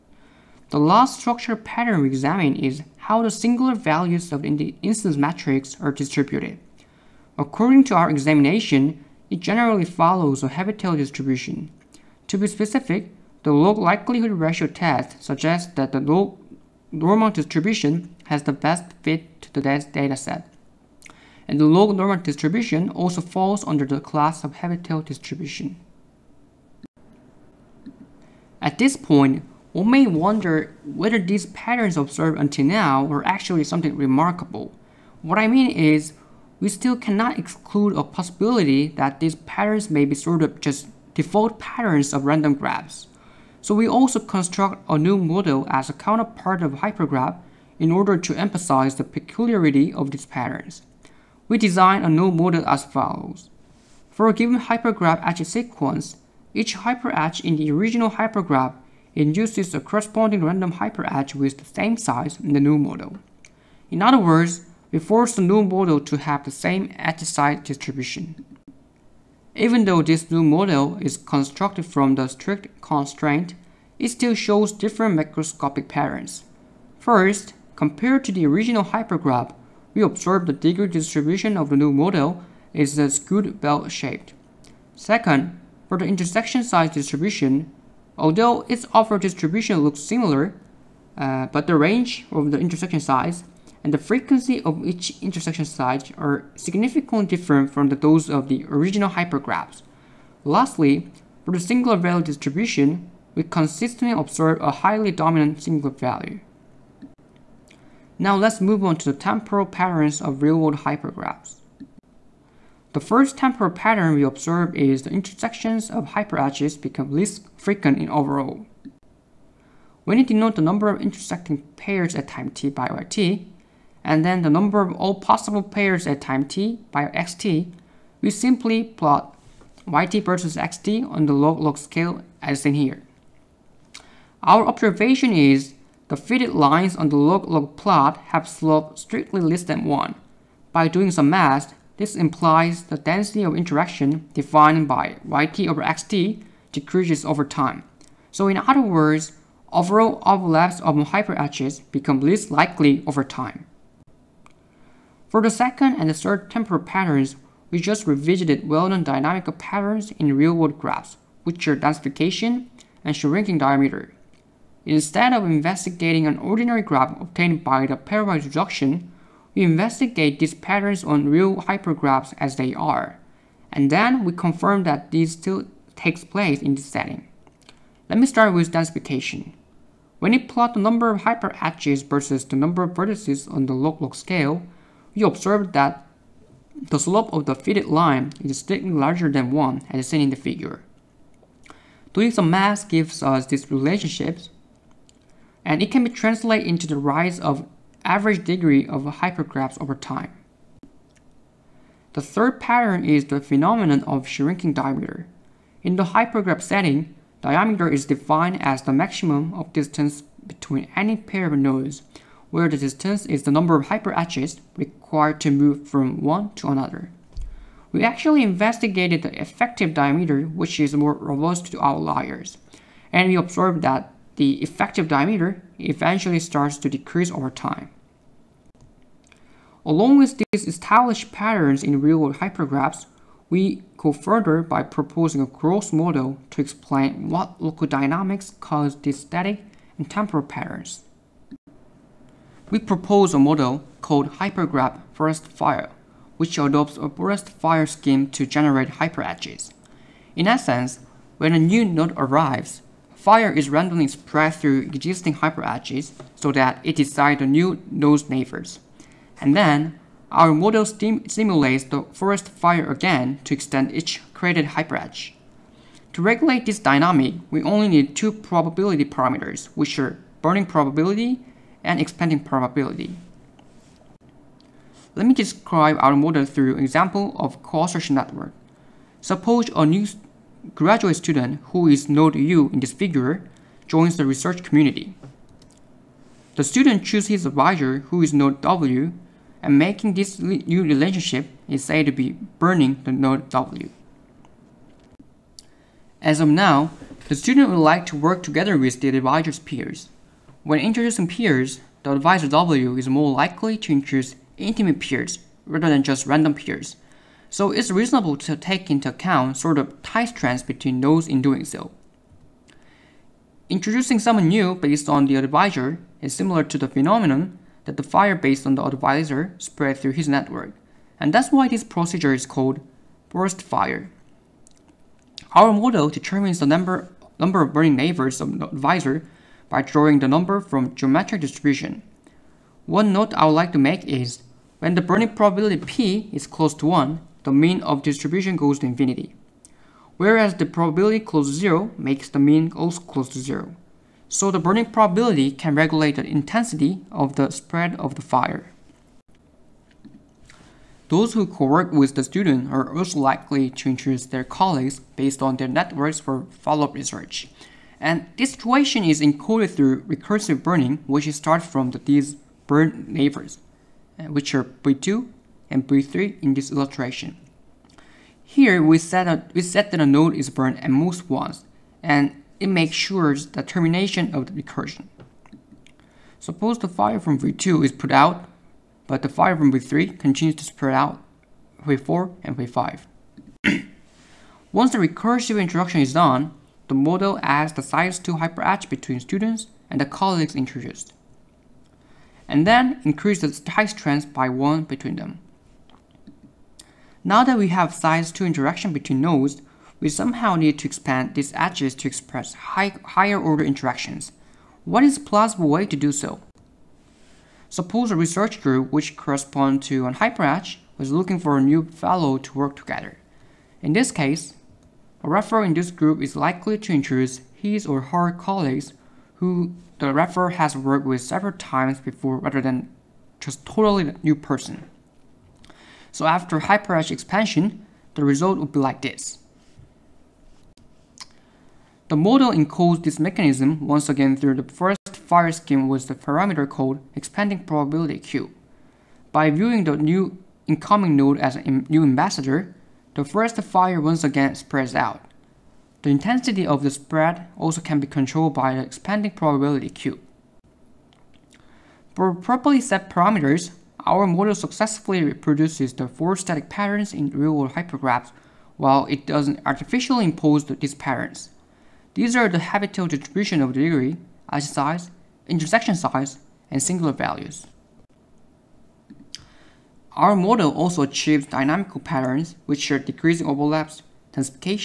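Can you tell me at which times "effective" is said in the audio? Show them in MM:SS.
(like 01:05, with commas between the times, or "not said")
03:39, 03:44.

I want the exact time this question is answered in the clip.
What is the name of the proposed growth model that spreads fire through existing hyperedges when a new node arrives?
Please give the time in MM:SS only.
04:04.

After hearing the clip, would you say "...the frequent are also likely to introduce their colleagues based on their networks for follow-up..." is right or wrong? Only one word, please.
wrong.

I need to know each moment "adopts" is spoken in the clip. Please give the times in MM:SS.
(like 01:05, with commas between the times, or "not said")
04:06.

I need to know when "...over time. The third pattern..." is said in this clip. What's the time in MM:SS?
03:19.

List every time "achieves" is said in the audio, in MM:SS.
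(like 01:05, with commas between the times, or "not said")
07:51.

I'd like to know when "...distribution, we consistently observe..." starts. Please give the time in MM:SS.
01:42.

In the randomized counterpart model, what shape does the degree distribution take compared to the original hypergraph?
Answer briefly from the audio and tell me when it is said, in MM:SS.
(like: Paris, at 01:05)
skewed bell-shaped, at 01:23.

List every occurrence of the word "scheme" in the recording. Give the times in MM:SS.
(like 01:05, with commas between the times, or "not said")
04:07, 07:15.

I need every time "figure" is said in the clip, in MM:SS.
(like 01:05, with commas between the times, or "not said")
03:10, 04:42.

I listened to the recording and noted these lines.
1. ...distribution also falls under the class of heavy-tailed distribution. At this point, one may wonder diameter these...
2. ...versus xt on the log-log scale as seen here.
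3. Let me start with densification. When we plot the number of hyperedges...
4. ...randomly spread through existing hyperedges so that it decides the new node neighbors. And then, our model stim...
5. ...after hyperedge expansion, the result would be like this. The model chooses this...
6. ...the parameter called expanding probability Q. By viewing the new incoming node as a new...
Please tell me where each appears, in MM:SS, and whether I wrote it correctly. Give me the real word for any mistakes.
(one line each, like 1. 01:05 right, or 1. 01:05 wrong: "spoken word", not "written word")
1. 00:22 wrong: "whether", not "diameter"
2. 02:10 right
3. 02:58 right
4. 04:13 right
5. 07:06 wrong: "encodes", not "chooses"
6. 07:16 right.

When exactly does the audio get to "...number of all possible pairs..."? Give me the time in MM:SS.
02:04.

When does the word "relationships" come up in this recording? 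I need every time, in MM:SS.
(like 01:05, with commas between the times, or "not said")
03:13, 04:50.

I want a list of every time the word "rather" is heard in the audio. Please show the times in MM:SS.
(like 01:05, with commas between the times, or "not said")
05:05, 07:02.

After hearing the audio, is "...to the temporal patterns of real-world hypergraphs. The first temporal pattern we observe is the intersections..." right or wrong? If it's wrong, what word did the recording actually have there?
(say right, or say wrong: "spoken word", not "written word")
right.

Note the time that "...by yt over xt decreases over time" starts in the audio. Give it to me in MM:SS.
02:24.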